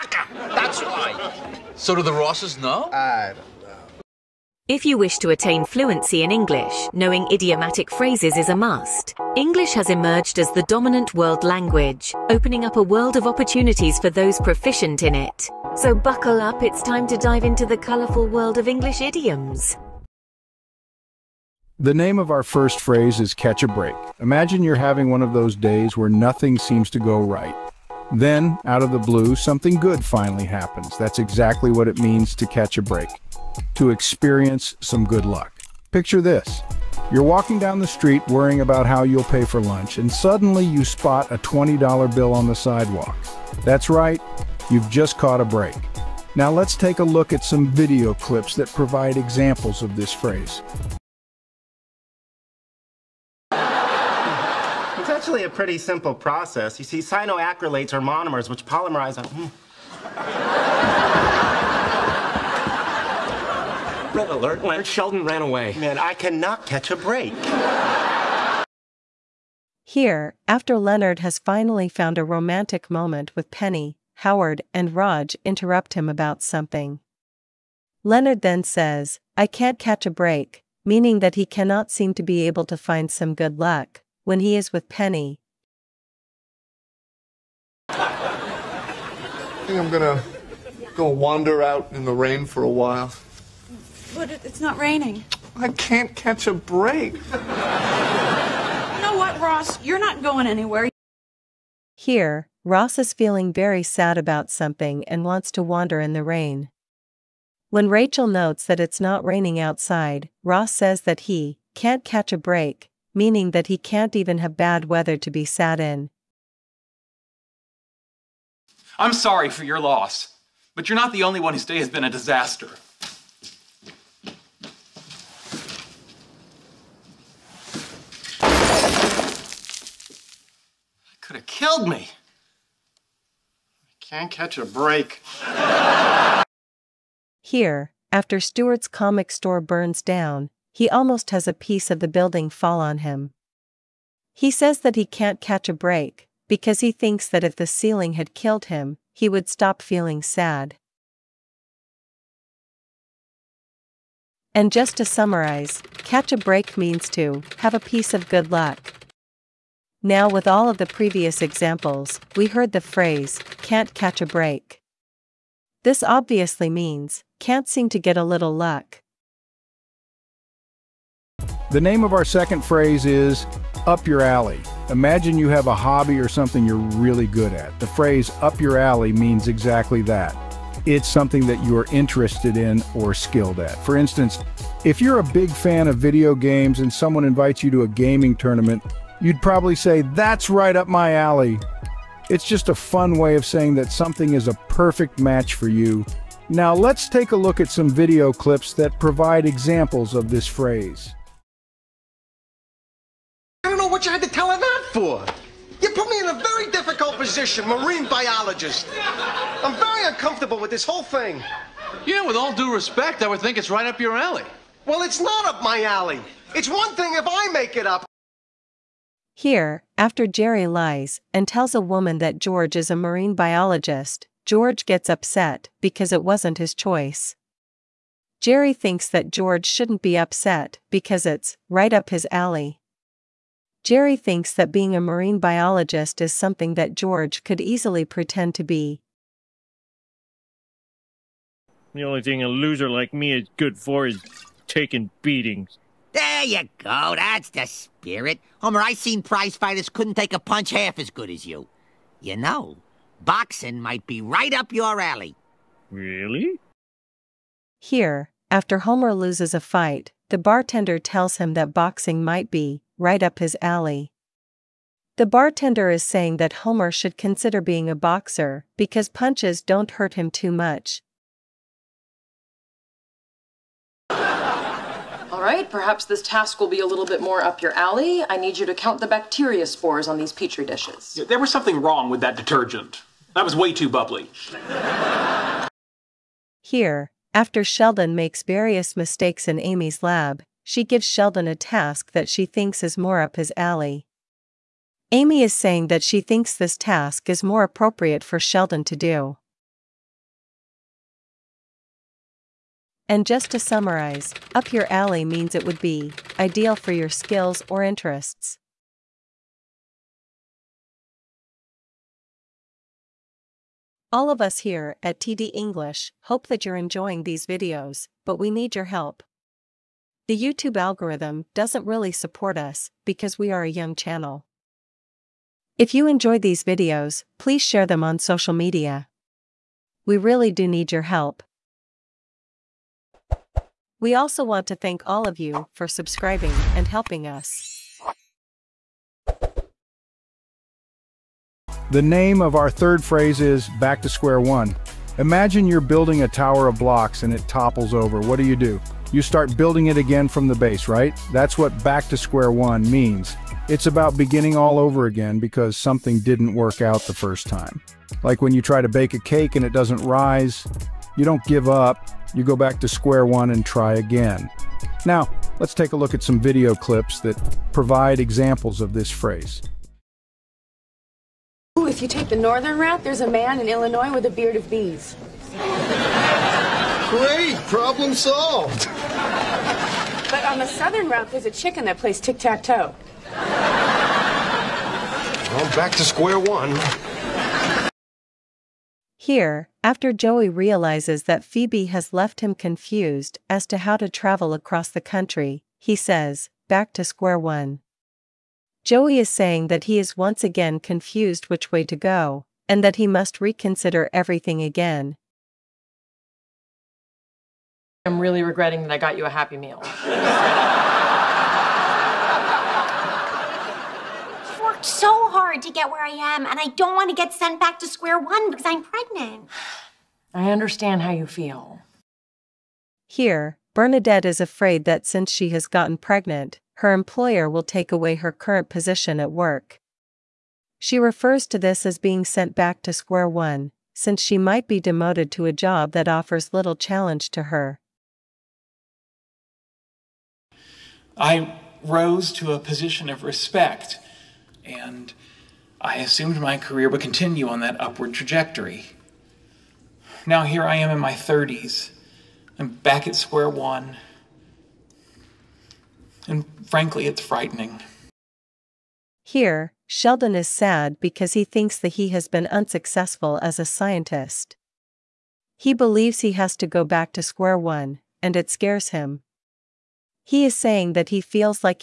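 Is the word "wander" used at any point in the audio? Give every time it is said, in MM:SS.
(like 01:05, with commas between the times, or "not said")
01:31, 01:45.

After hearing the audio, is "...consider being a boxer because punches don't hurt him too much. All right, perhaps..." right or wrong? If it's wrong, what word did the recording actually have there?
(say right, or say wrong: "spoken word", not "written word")
right.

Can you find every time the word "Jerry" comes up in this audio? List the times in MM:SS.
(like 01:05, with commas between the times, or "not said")
03:40, 03:48, 03:53.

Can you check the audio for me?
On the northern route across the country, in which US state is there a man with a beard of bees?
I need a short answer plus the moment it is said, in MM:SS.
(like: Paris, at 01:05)
Illinois, at 06:13.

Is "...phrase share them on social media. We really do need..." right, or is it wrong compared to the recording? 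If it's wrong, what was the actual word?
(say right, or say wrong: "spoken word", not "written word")
wrong: "please", not "phrase".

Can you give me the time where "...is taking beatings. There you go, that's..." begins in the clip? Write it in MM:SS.
04:04.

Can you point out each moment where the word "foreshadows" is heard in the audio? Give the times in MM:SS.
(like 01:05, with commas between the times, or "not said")
not said.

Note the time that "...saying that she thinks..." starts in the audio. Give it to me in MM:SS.
04:55.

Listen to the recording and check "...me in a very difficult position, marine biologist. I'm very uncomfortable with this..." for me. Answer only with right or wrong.
right.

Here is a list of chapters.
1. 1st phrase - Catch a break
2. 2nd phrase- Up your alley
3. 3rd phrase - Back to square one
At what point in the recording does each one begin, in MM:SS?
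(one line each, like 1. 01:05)
1. 00:20
2. 02:51
3. 05:42.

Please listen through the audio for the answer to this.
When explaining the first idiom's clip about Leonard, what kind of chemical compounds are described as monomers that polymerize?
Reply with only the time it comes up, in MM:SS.
00:56.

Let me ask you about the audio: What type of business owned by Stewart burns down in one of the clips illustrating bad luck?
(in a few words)
comic store.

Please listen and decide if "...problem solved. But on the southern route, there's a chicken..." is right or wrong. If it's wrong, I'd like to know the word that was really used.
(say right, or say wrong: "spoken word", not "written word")
right.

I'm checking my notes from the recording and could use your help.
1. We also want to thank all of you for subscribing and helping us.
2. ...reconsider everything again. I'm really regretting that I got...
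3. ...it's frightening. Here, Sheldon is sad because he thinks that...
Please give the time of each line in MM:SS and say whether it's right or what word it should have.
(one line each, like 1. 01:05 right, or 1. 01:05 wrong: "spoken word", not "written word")
1. 05:33 right
2. 06:43 right
3. 07:37 right.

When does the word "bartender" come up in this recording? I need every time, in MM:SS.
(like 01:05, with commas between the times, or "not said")
04:20, 04:25.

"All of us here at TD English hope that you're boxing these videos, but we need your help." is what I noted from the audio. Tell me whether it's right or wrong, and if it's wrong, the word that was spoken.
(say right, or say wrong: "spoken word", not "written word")
wrong: "enjoying", not "boxing".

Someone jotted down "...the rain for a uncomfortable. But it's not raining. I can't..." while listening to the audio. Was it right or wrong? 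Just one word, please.
wrong.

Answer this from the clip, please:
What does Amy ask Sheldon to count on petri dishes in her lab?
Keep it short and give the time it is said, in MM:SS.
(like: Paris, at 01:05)
bacteria spores, at 04:39.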